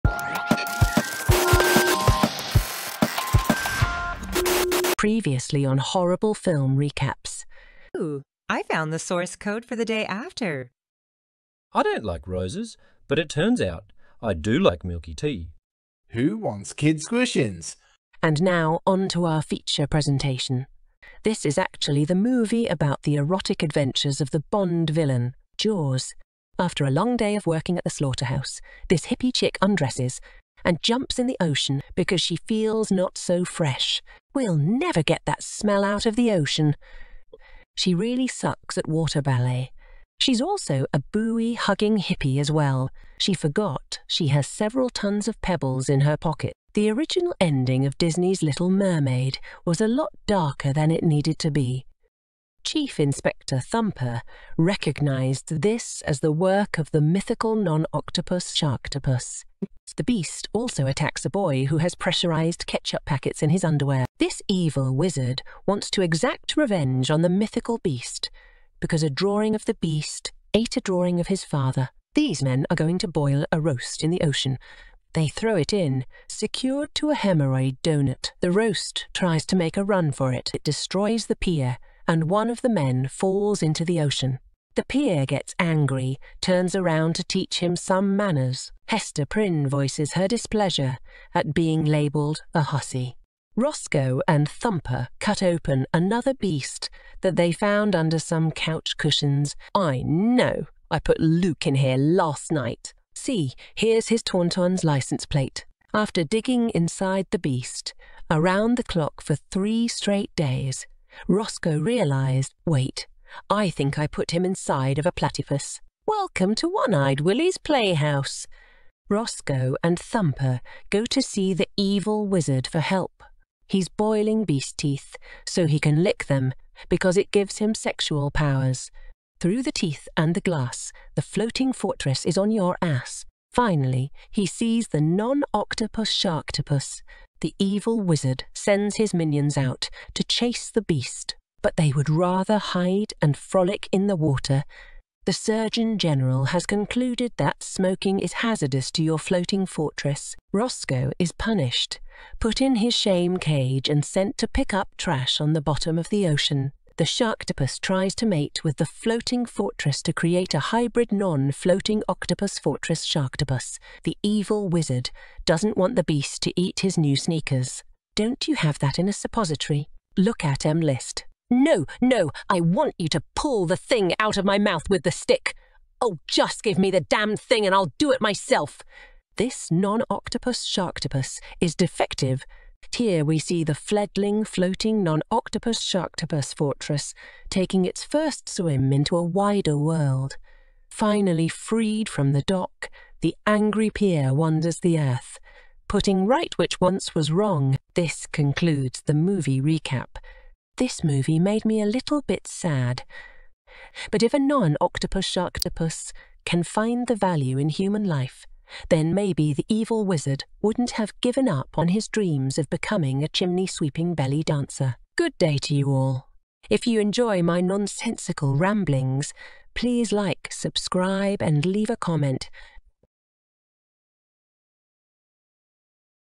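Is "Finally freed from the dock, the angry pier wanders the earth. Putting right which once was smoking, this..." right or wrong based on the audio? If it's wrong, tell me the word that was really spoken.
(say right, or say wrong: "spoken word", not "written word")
wrong: "wrong", not "smoking".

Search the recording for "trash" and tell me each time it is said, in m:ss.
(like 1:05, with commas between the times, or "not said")
2:34.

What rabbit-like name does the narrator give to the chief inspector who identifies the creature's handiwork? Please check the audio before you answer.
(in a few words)
Chief Inspector Thumper.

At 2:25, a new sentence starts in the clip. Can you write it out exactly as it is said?
The Surgeon General has concluded that smoking is hazardous to your floating fortress.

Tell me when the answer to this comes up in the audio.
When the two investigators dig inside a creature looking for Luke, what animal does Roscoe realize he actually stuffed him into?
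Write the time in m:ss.
1:55.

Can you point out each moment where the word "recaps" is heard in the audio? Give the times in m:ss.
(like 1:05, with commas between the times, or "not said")
0:06, 3:19.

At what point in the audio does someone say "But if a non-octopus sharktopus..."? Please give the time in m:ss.
3:24.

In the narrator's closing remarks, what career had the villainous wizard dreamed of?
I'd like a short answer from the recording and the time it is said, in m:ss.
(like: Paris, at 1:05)
Chimney-sweeping belly dancer, at 3:33.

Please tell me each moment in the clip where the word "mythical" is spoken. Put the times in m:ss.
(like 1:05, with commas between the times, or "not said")
0:57, 1:07.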